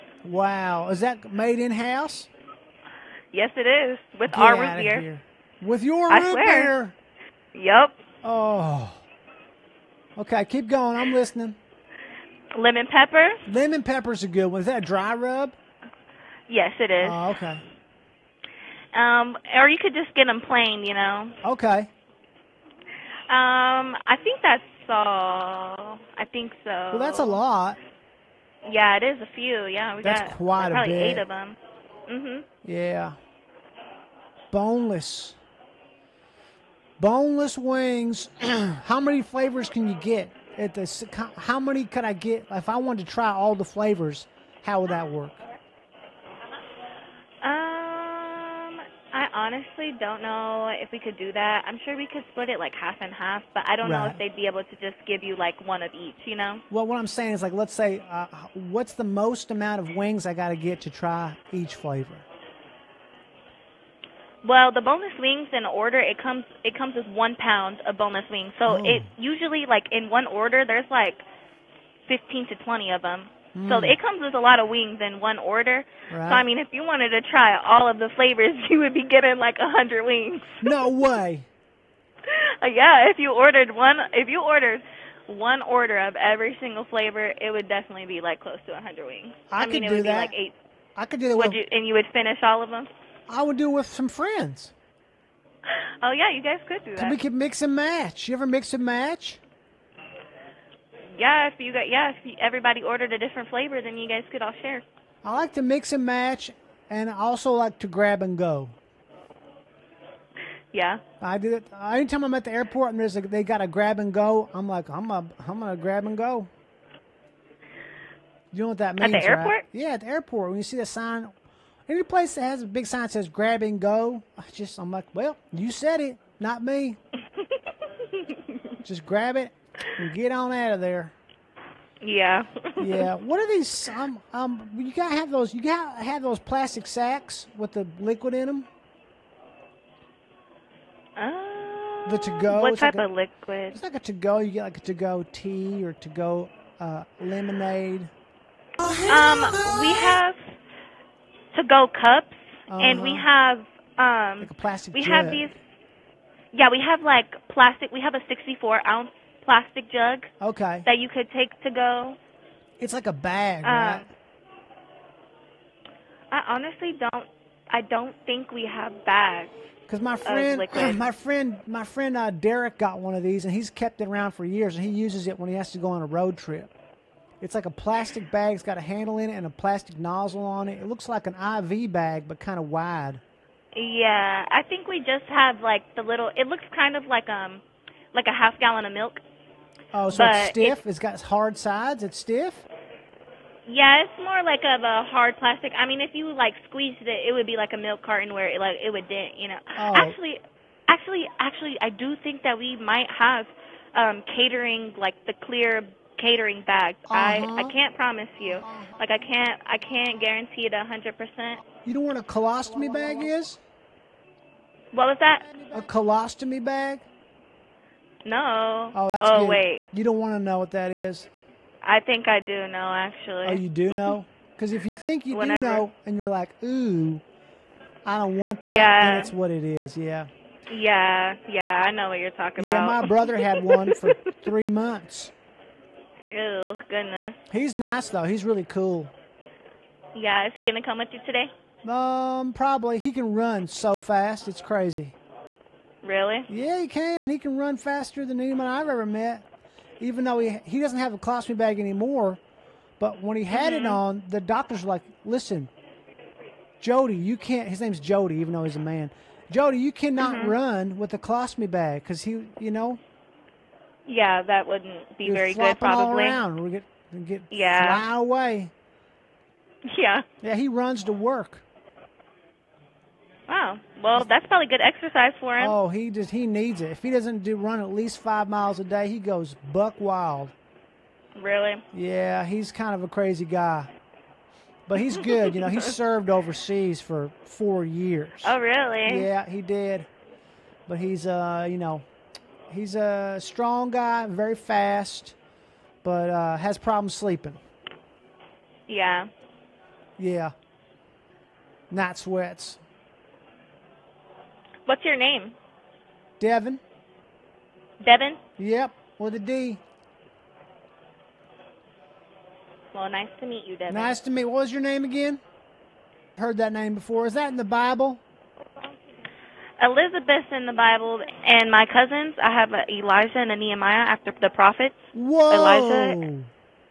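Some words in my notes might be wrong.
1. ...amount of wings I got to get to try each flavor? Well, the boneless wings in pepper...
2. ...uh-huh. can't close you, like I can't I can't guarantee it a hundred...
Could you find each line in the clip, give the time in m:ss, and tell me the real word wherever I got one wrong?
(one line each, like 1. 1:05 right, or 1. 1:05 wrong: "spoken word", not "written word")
1. 0:59 wrong: "order", not "pepper"
2. 3:27 wrong: "promise", not "close".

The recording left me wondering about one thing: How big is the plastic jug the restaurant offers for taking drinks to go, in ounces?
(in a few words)
64.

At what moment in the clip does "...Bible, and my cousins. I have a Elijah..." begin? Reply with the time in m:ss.
5:20.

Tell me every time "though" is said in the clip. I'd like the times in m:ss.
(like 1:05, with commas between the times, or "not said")
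3:58, 4:10, 4:18.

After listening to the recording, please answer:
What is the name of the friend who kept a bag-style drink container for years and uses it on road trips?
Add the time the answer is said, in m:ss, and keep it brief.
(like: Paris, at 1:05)
Derek, at 2:52.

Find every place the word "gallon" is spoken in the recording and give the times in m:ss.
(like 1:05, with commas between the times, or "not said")
3:08.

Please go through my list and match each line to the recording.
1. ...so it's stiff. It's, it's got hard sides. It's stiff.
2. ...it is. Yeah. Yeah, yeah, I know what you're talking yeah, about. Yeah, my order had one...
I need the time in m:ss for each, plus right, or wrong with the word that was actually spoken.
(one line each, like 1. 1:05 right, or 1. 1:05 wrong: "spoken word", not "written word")
1. 3:10 right
2. 3:49 wrong: "brother", not "order".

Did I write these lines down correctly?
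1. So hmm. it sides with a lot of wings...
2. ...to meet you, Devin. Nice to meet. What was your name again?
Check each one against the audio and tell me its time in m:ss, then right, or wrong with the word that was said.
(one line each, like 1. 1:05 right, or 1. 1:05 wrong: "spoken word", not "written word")
1. 1:13 wrong: "comes", not "sides"
2. 5:13 right.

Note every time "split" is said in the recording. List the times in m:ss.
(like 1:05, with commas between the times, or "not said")
0:52.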